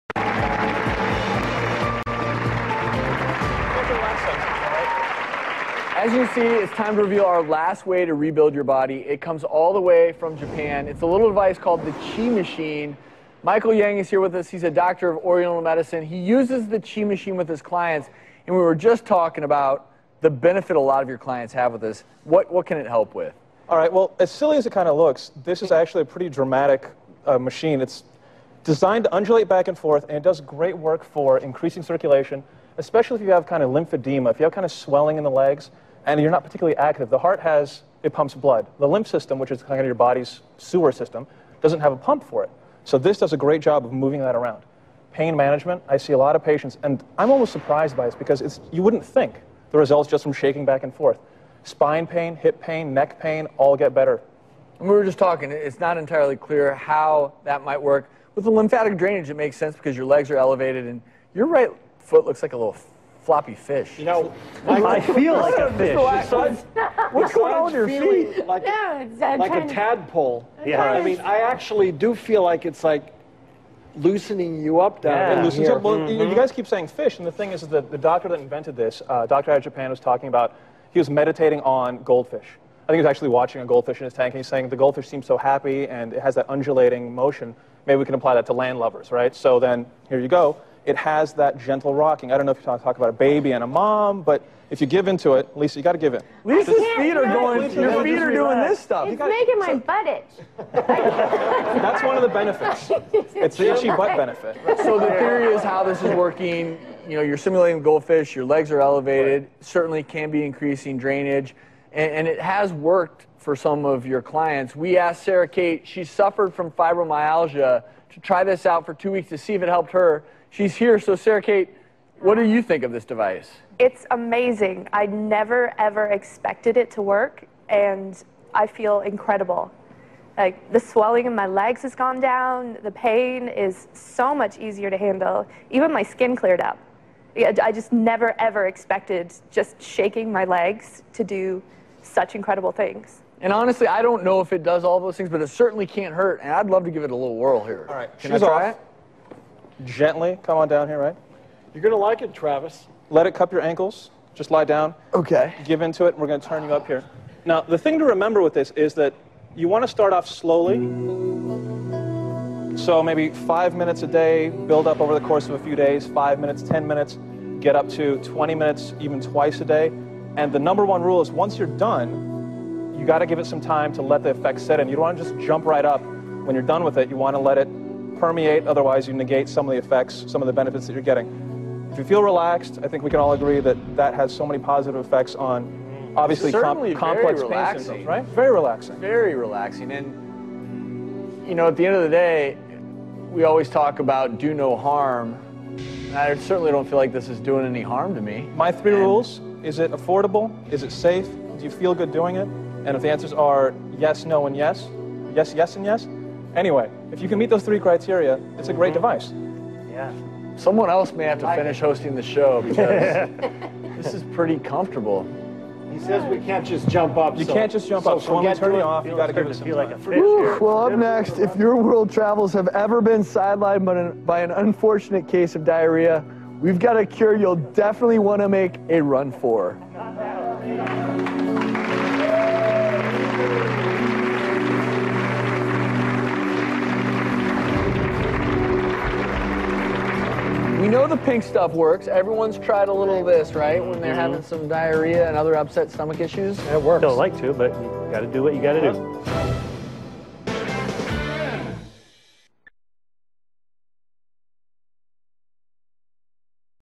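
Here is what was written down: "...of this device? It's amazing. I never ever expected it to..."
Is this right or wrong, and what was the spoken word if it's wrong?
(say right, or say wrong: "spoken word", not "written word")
right.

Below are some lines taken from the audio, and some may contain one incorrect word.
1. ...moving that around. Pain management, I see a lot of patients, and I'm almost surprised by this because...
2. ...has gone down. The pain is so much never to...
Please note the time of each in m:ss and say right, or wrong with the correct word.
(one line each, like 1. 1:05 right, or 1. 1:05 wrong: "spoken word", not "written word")
1. 0:43 right
2. 2:11 wrong: "easier", not "never".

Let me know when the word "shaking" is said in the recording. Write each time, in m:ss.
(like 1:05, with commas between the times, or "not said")
0:50, 2:19.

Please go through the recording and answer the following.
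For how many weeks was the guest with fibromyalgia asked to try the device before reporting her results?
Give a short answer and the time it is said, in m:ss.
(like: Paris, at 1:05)
2, at 1:58.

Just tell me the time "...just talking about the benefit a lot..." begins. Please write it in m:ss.
0:18.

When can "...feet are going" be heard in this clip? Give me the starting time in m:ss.
1:36.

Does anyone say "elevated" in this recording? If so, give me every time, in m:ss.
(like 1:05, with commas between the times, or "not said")
1:00, 1:48.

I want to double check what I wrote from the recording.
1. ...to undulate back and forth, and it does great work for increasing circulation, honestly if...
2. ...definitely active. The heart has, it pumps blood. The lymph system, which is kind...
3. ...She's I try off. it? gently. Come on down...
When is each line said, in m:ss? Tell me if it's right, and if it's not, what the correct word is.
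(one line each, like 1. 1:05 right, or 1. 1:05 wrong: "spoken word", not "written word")
1. 0:29 wrong: "especially", not "honestly"
2. 0:36 wrong: "particularly", not "definitely"
3. 2:28 right.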